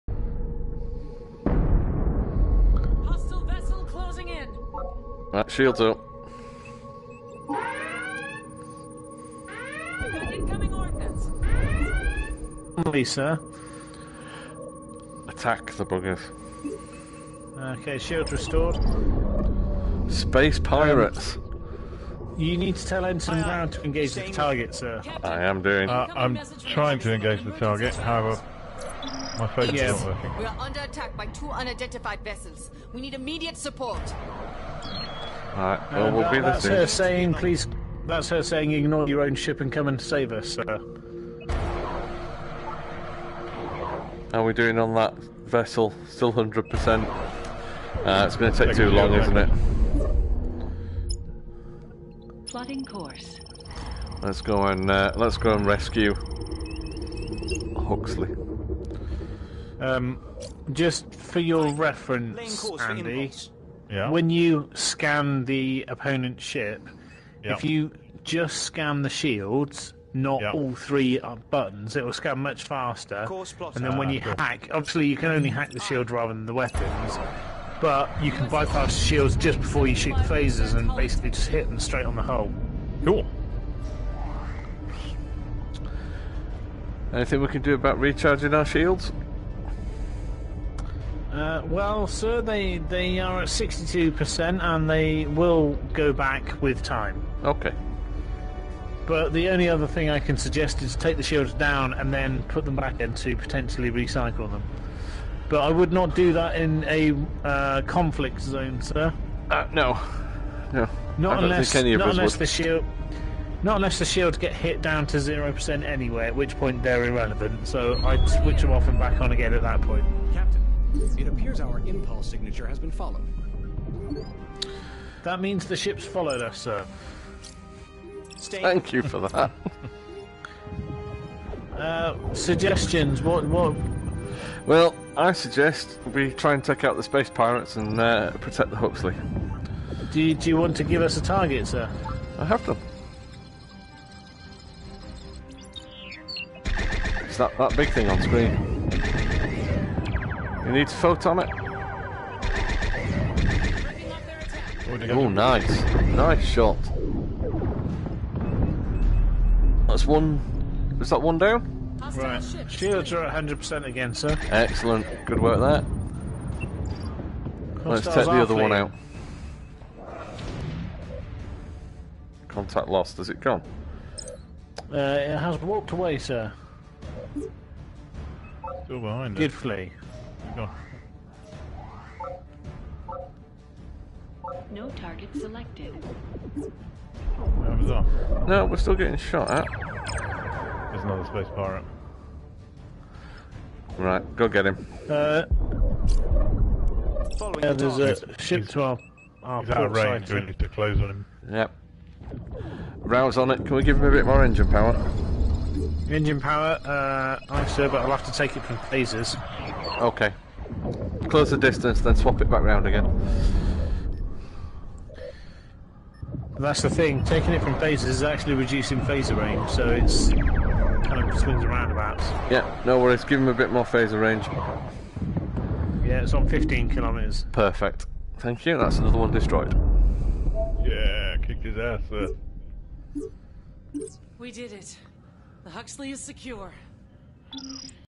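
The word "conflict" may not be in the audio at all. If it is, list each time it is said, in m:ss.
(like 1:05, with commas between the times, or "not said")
1:47.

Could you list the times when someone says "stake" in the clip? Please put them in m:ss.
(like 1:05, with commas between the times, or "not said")
not said.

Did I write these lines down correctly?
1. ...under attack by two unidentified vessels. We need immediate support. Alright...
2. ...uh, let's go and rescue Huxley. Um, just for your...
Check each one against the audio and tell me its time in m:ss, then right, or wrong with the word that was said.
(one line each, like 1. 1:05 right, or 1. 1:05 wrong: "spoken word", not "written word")
1. 0:30 right
2. 0:54 right.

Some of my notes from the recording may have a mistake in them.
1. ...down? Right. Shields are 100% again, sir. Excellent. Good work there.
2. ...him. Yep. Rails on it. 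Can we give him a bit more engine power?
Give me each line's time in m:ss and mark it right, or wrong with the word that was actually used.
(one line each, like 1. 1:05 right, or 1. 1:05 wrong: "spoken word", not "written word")
1. 2:41 right
2. 3:21 right.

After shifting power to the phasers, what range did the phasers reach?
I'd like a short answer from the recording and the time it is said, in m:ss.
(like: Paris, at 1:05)
15 kilometres, at 3:46.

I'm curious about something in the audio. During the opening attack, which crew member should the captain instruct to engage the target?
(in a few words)
Ensign Brown.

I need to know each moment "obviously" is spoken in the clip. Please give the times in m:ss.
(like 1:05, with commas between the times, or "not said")
1:14.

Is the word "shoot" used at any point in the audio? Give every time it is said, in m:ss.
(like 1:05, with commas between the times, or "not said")
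1:19.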